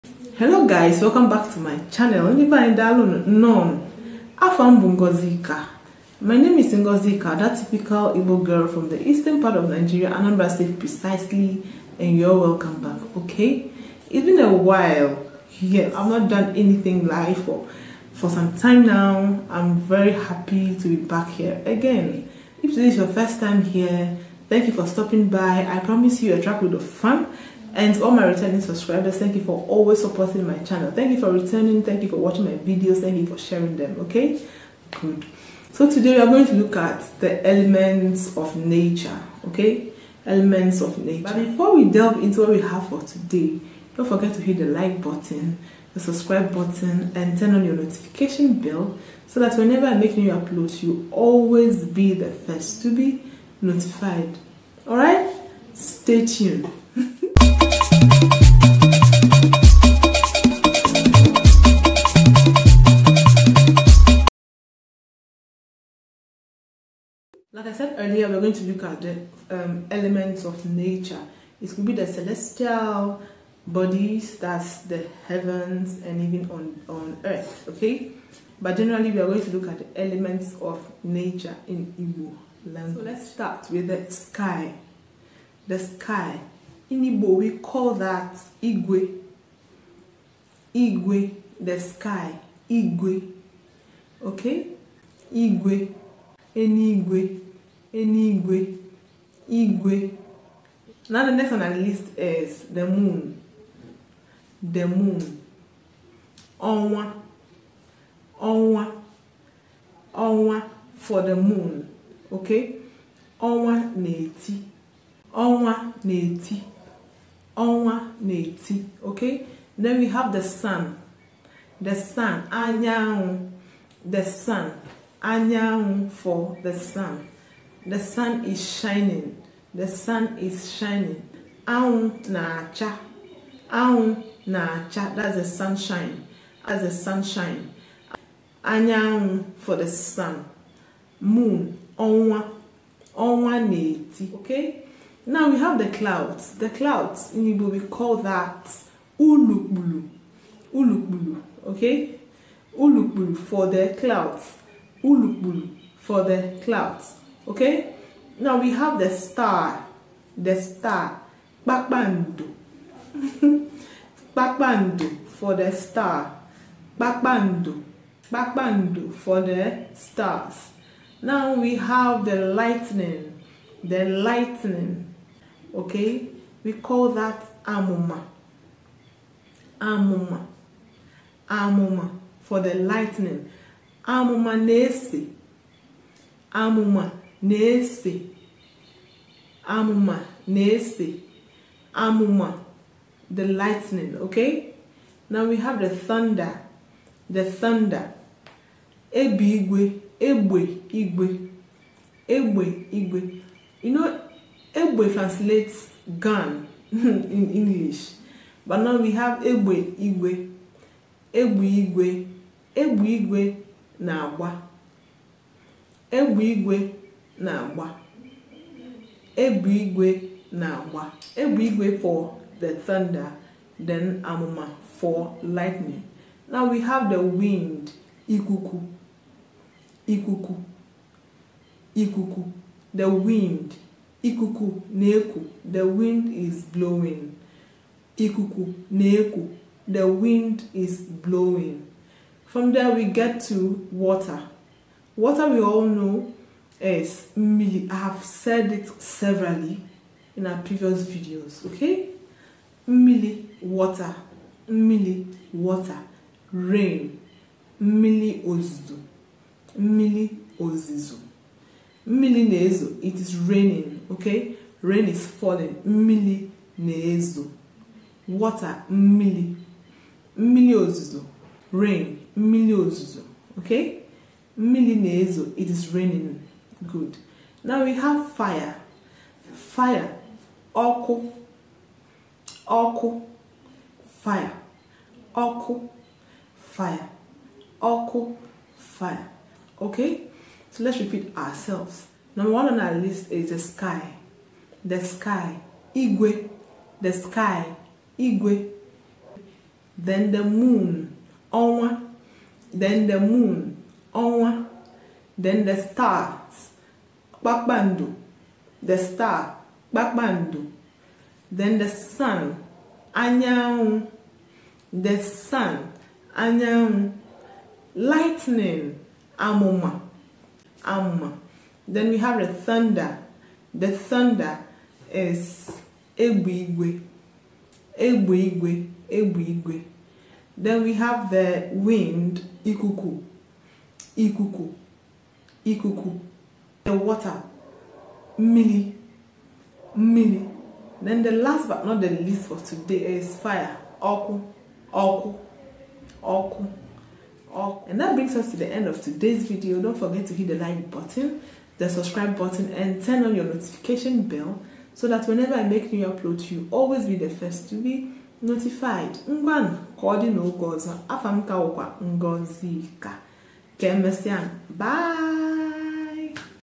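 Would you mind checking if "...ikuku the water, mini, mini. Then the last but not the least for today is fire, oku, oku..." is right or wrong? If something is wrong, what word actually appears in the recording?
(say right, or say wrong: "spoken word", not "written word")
right.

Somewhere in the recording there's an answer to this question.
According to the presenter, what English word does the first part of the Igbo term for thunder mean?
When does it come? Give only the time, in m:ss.
3:26.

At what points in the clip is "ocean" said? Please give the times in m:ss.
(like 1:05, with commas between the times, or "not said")
not said.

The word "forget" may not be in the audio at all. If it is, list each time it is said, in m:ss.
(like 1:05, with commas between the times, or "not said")
0:44, 5:49.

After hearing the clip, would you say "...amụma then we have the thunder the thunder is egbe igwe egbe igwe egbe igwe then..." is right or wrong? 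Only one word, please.
right.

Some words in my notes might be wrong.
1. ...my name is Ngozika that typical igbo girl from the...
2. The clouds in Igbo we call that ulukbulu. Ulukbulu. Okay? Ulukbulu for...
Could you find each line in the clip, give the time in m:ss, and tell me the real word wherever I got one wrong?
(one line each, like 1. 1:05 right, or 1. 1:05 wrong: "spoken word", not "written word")
1. 0:06 right
2. 2:26 right.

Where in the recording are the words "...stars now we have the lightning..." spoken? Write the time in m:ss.
2:49.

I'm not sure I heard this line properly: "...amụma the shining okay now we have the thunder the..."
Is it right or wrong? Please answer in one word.
wrong.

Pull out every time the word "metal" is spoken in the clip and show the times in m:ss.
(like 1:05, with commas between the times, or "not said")
not said.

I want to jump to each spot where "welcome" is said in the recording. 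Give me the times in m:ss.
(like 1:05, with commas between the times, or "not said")
0:01, 0:12.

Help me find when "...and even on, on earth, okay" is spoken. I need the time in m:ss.
1:16.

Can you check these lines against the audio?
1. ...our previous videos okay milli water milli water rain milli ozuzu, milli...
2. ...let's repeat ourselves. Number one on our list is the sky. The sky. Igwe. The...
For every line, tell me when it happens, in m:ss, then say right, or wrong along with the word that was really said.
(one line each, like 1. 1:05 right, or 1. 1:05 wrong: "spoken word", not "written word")
1. 4:10 right
2. 4:50 right.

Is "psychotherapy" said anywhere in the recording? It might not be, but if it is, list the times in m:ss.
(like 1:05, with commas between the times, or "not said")
not said.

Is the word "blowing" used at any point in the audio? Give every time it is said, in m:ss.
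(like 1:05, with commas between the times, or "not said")
3:56, 4:01.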